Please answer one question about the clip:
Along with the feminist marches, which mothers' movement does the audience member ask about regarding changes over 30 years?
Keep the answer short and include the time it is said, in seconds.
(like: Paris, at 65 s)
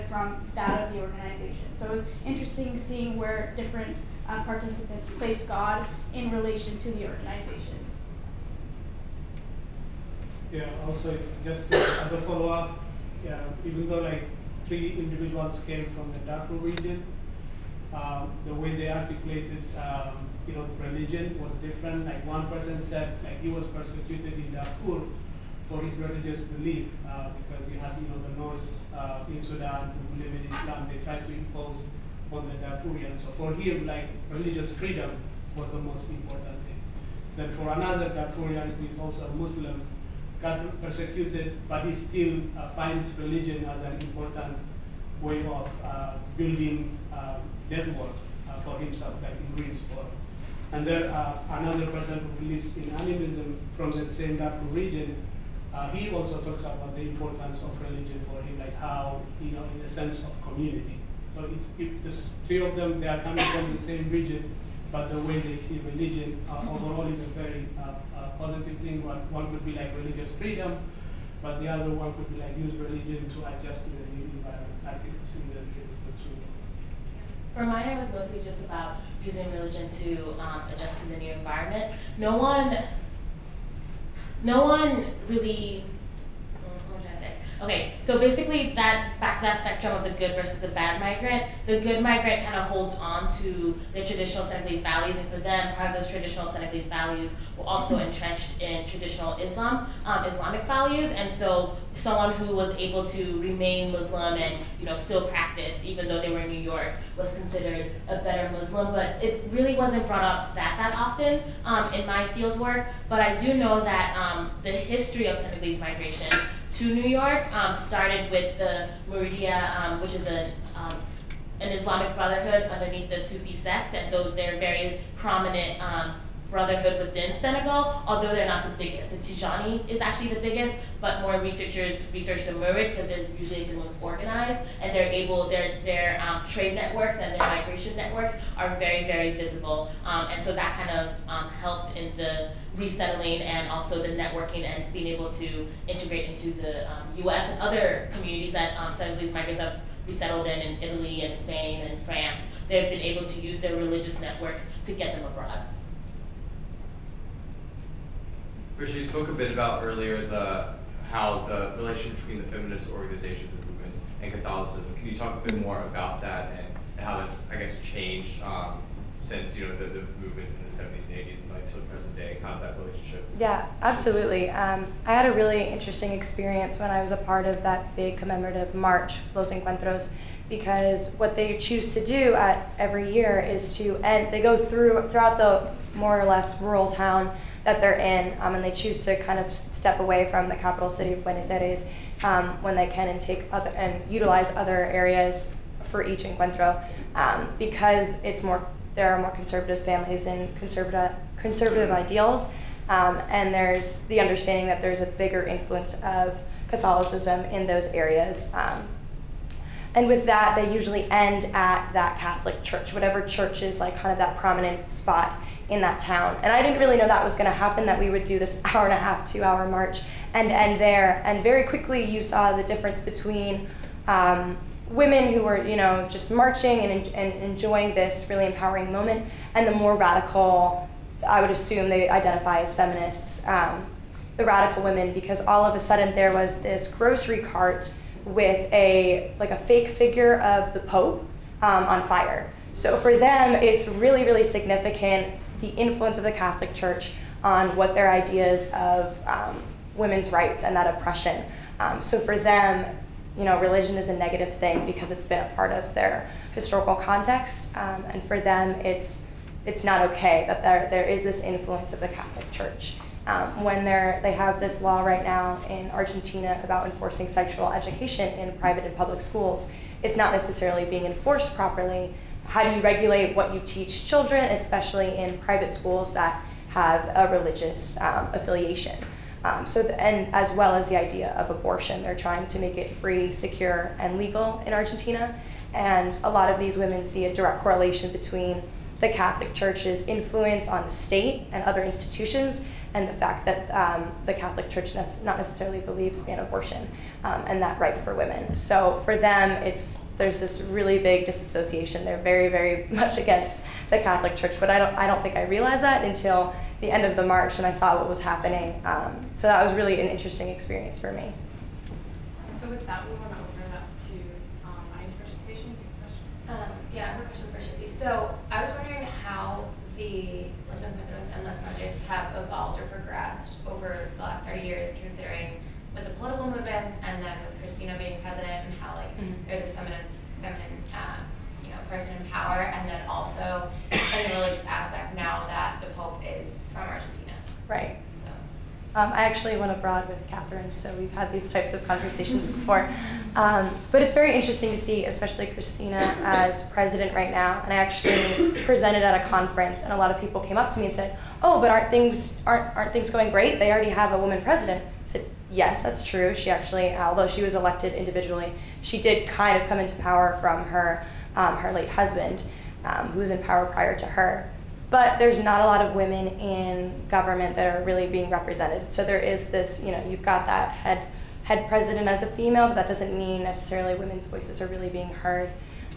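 Las Madres, at 321 s.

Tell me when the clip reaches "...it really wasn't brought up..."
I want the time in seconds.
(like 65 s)
109 s.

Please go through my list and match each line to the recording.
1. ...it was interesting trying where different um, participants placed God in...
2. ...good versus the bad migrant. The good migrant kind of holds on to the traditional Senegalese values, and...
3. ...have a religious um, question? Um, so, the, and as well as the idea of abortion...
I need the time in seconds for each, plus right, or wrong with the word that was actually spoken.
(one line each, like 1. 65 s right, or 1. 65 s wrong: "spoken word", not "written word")
1. 1 s wrong: "seeing", not "trying"
2. 90 s right
3. 276 s wrong: "affiliation", not "question".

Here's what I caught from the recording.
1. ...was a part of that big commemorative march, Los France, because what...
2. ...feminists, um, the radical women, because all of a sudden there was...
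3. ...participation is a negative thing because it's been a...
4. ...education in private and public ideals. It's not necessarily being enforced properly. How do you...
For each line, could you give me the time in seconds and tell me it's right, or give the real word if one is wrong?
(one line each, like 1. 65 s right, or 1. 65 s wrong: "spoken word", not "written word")
1. 177 s wrong: "Encuentros", not "France"
2. 232 s right
3. 253 s wrong: "religion", not "participation"
4. 267 s wrong: "schools", not "ideals".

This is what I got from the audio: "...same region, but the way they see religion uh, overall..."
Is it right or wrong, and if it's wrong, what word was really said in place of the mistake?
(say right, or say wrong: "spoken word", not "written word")
right.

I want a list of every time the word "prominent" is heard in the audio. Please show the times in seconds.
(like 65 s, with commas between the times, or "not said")
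125 s, 214 s.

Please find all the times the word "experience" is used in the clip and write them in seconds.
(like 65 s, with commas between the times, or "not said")
176 s, 310 s.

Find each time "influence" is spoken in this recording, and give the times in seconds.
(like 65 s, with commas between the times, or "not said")
205 s, 245 s, 261 s, 290 s.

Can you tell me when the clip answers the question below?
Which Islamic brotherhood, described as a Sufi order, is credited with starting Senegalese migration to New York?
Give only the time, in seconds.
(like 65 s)
119 s.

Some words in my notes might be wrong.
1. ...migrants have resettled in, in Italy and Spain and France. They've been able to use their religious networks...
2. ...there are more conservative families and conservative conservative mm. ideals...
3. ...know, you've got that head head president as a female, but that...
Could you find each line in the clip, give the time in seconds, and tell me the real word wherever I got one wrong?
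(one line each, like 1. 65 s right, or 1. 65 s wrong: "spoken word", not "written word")
1. 149 s right
2. 198 s right
3. 369 s right.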